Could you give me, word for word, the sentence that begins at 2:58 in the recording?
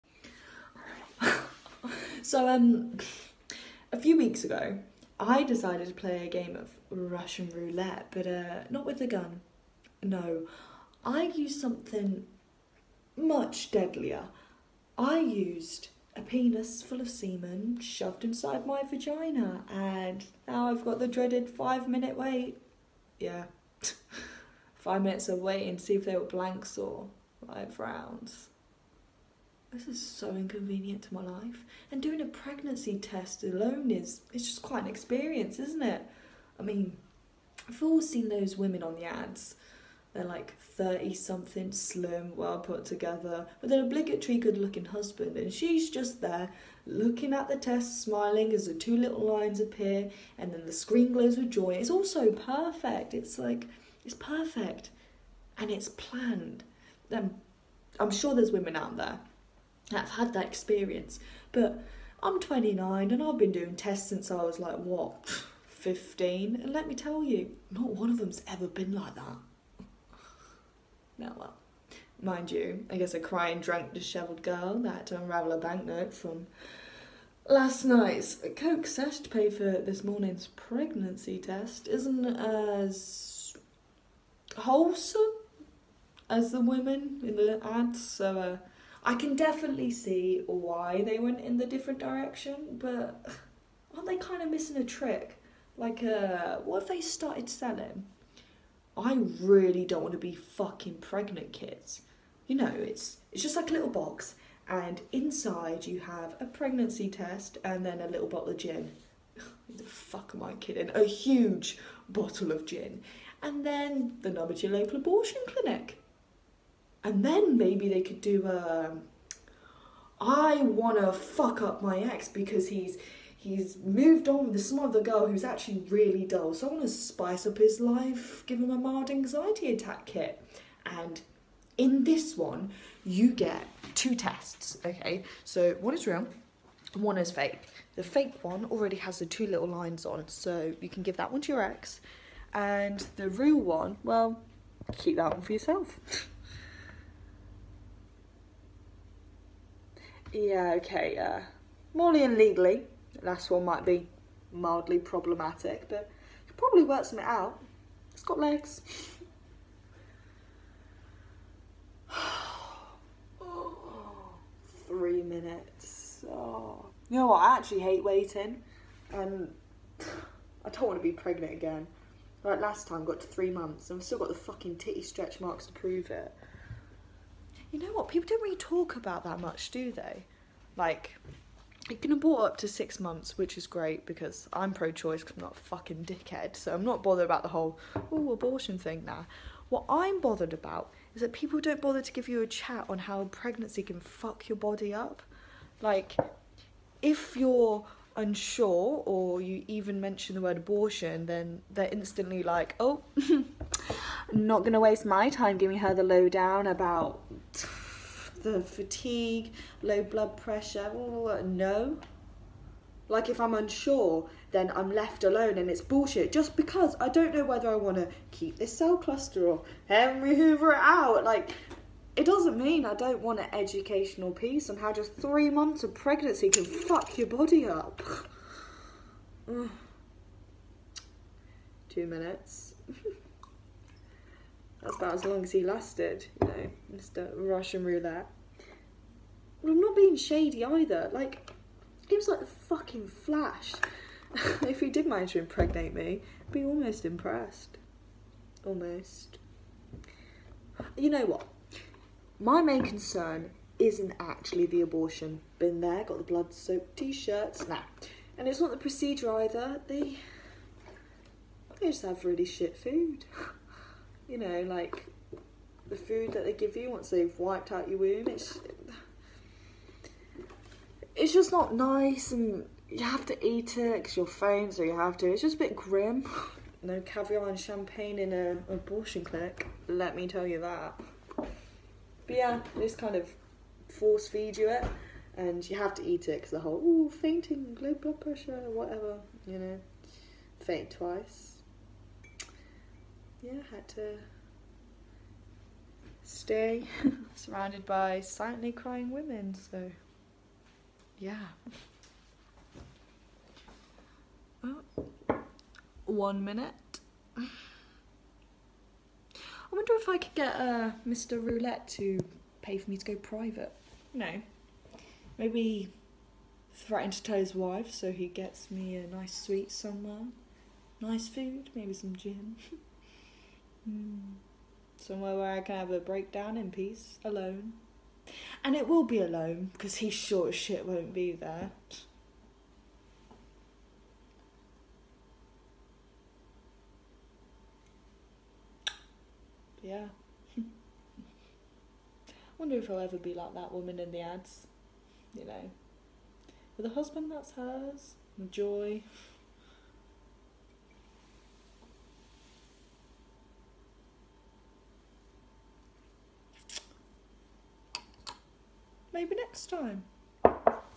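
People don't really talk about that much, do they?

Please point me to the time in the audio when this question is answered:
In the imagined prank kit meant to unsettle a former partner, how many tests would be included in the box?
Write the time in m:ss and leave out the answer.
2:13.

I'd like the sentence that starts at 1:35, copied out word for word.
Like, uh, what if they started selling?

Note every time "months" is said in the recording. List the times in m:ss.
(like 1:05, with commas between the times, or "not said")
2:53, 3:02, 3:45.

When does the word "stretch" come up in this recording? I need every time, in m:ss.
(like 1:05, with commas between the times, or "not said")
2:55.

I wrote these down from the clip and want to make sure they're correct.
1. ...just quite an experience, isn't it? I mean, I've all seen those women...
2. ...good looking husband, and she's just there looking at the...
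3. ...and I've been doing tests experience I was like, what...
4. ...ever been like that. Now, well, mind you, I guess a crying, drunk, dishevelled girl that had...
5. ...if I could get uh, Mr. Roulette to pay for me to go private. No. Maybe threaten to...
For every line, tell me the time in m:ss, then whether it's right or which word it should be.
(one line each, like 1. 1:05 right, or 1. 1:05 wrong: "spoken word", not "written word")
1. 0:34 right
2. 0:44 right
3. 1:03 wrong: "since", not "experience"
4. 1:08 right
5. 5:09 right.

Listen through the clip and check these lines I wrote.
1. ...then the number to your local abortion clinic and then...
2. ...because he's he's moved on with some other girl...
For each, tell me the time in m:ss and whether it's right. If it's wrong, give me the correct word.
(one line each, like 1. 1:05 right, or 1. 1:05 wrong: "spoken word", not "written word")
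1. 1:53 right
2. 2:02 right.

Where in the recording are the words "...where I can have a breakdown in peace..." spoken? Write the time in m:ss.
5:25.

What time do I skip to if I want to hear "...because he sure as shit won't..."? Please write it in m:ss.
5:29.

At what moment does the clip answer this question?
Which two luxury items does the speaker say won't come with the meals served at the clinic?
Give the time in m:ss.
4:37.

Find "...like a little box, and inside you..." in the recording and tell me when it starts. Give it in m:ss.
1:43.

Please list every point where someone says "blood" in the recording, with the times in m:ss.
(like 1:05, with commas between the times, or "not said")
3:30, 4:16, 4:47.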